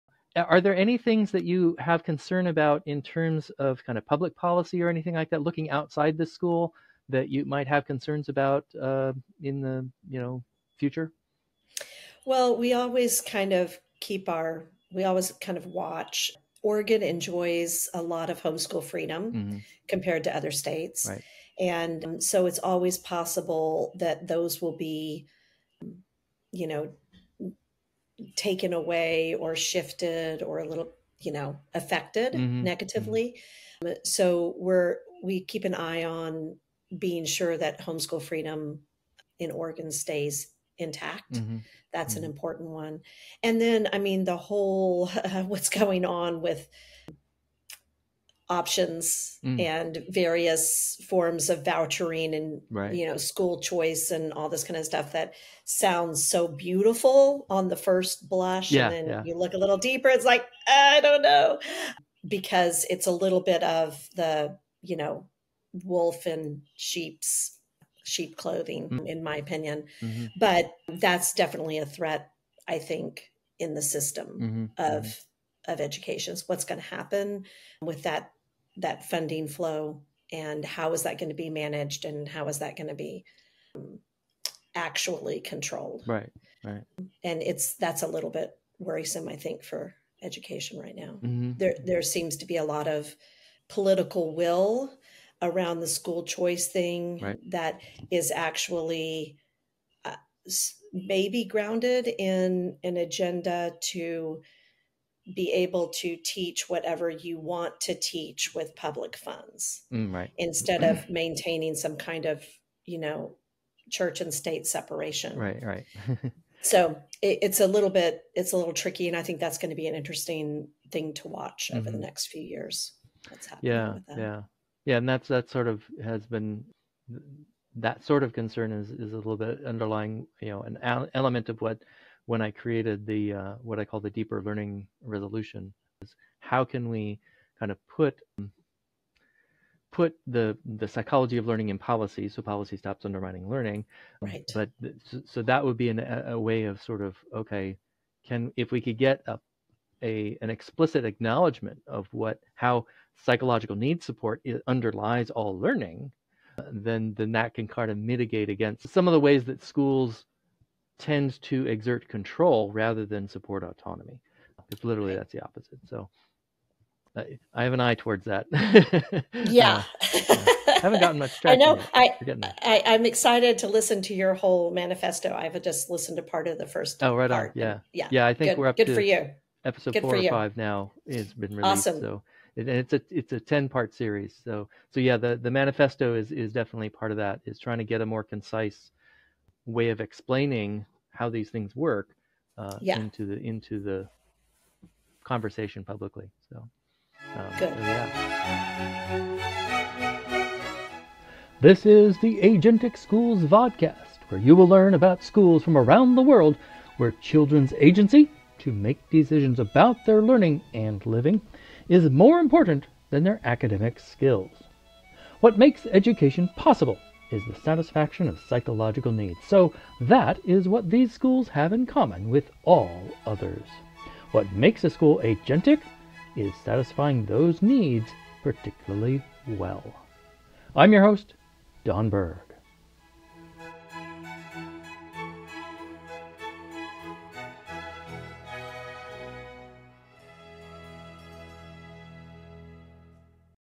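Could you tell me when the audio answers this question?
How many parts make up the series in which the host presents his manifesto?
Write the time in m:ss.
3:03.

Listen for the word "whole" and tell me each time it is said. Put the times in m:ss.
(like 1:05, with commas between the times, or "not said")
0:44, 2:54.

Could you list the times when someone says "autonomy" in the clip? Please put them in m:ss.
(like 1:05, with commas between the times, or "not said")
2:43.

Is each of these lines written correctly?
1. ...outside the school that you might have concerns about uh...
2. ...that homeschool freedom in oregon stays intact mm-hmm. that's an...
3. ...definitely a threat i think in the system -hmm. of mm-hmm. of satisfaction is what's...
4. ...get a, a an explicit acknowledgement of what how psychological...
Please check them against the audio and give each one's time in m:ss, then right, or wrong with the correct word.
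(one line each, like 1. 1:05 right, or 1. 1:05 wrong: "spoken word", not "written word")
1. 0:05 right
2. 0:37 right
3. 1:11 wrong: "education", not "satisfaction"
4. 2:28 right.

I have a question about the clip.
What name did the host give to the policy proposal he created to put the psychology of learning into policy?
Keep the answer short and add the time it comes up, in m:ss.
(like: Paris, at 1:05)
Deeper learning resolution, at 2:14.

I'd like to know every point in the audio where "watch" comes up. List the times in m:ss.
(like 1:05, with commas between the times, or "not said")
0:15, 2:01.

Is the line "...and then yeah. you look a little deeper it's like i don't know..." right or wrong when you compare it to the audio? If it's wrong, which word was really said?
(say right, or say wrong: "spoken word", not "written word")
right.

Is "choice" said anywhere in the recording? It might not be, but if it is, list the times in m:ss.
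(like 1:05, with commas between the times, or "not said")
0:53, 1:36.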